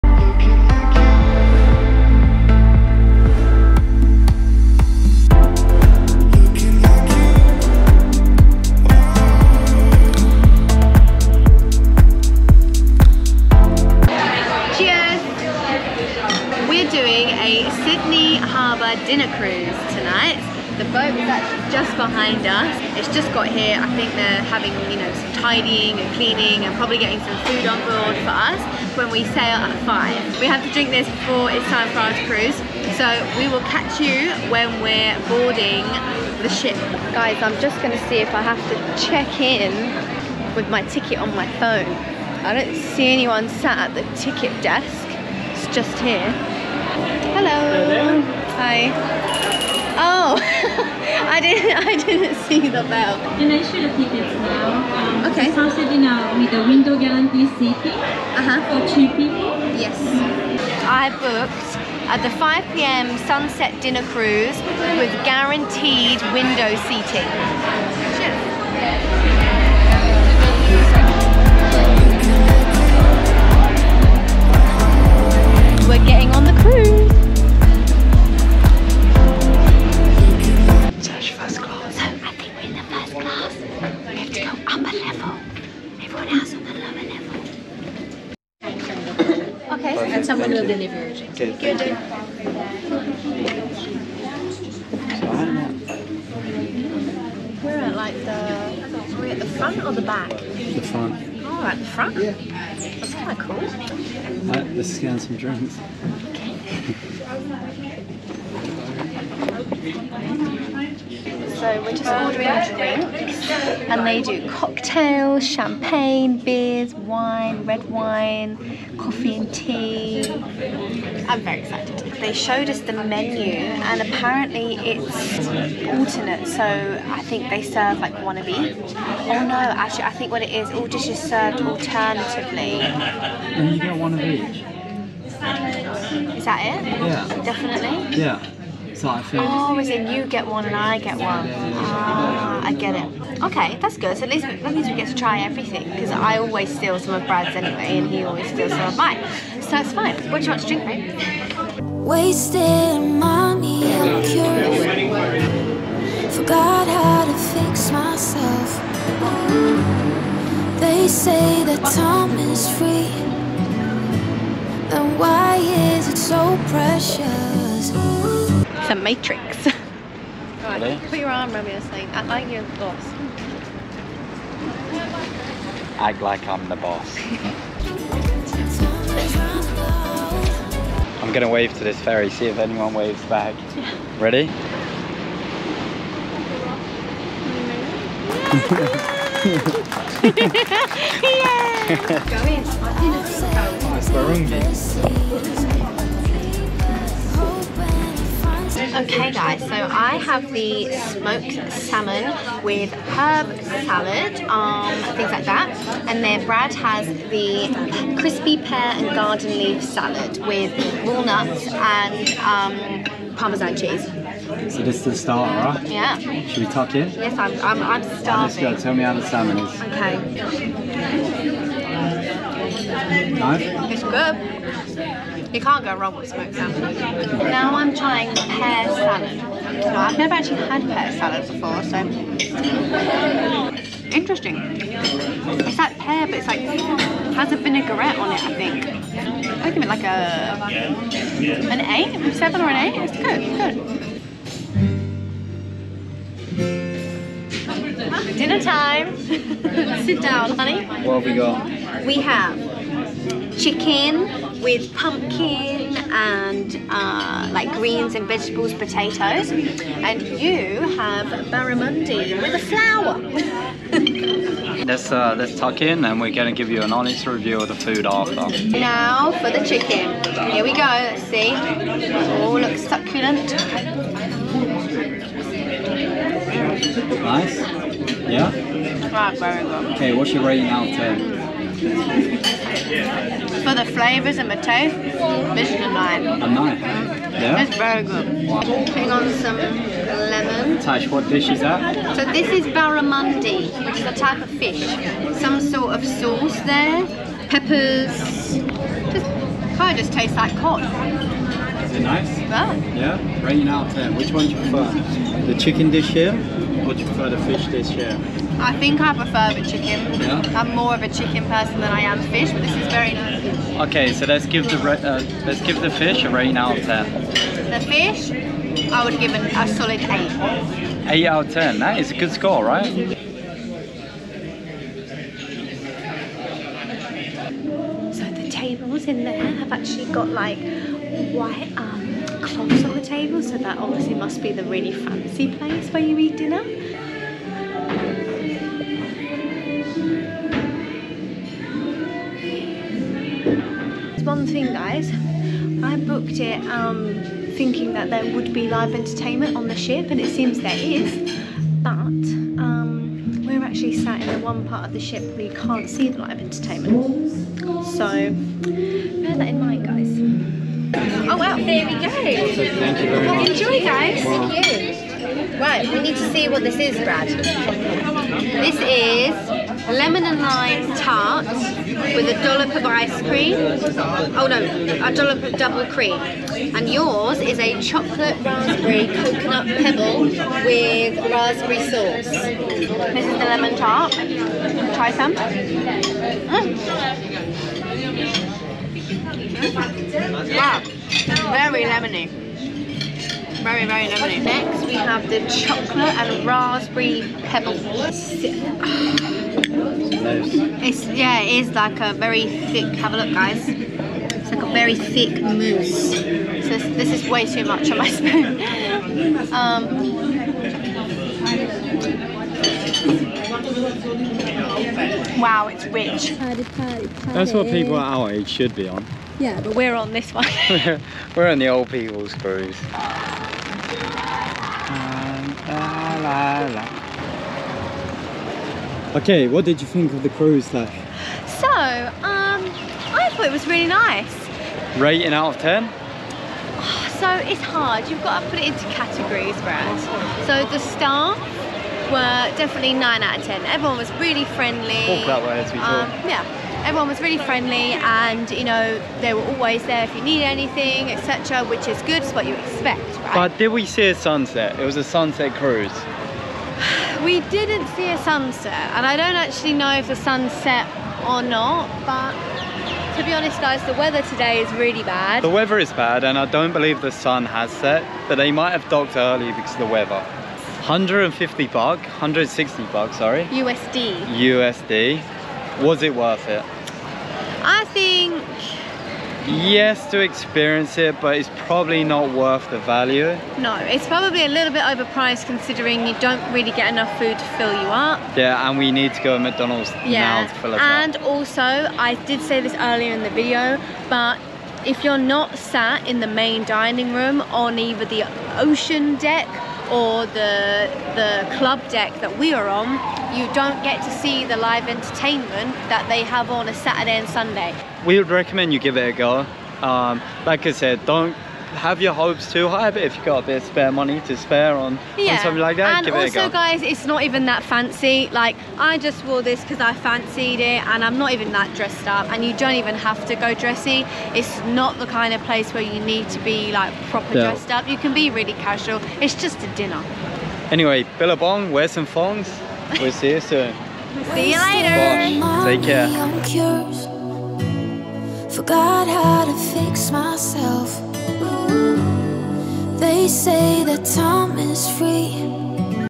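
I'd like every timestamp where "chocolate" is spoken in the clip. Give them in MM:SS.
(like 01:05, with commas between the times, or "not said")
06:17, 06:35.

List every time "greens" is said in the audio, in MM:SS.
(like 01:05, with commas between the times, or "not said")
04:17.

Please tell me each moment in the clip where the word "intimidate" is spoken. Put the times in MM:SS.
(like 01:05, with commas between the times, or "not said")
not said.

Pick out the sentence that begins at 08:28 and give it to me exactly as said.
We would recommend you give it a go.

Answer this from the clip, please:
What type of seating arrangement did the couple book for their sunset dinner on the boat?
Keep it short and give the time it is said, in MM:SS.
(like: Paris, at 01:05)
guaranteed window seating, at 01:05.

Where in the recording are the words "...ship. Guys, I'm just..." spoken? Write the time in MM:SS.
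00:36.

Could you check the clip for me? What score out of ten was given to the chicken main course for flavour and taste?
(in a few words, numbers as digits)
9.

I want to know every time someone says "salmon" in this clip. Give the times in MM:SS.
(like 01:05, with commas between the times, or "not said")
03:21, 03:39, 03:46.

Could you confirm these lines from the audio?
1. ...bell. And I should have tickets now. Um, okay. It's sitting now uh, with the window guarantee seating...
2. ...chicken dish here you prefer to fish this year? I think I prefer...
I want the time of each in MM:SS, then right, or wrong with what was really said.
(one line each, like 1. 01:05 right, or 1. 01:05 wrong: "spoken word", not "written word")
1. 00:52 right
2. 05:05 right.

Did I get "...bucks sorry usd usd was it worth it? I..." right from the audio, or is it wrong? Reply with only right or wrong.
right.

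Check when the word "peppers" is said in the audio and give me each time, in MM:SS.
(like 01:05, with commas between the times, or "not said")
04:57.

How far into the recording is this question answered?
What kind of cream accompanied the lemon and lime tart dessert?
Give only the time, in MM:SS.
06:15.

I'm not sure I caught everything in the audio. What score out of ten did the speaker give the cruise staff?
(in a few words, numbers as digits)
9.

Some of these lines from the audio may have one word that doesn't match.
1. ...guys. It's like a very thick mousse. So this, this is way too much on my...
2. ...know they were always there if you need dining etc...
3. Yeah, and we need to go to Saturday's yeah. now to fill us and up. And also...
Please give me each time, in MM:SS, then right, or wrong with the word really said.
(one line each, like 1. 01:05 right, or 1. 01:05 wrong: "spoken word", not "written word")
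1. 06:43 right
2. 07:28 wrong: "anything", not "dining"
3. 08:08 wrong: "McDonald", not "Saturday".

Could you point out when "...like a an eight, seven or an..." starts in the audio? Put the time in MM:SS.
03:59.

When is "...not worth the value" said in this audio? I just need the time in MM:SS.
08:02.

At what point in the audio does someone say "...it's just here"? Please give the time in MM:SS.
00:45.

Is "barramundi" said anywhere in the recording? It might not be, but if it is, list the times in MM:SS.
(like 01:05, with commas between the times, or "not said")
04:21, 04:52.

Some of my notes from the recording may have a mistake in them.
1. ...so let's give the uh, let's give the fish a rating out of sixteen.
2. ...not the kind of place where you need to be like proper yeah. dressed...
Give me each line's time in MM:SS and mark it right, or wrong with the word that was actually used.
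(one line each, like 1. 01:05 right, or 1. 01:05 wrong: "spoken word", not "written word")
1. 05:14 wrong: "ten", not "sixteen"
2. 08:44 right.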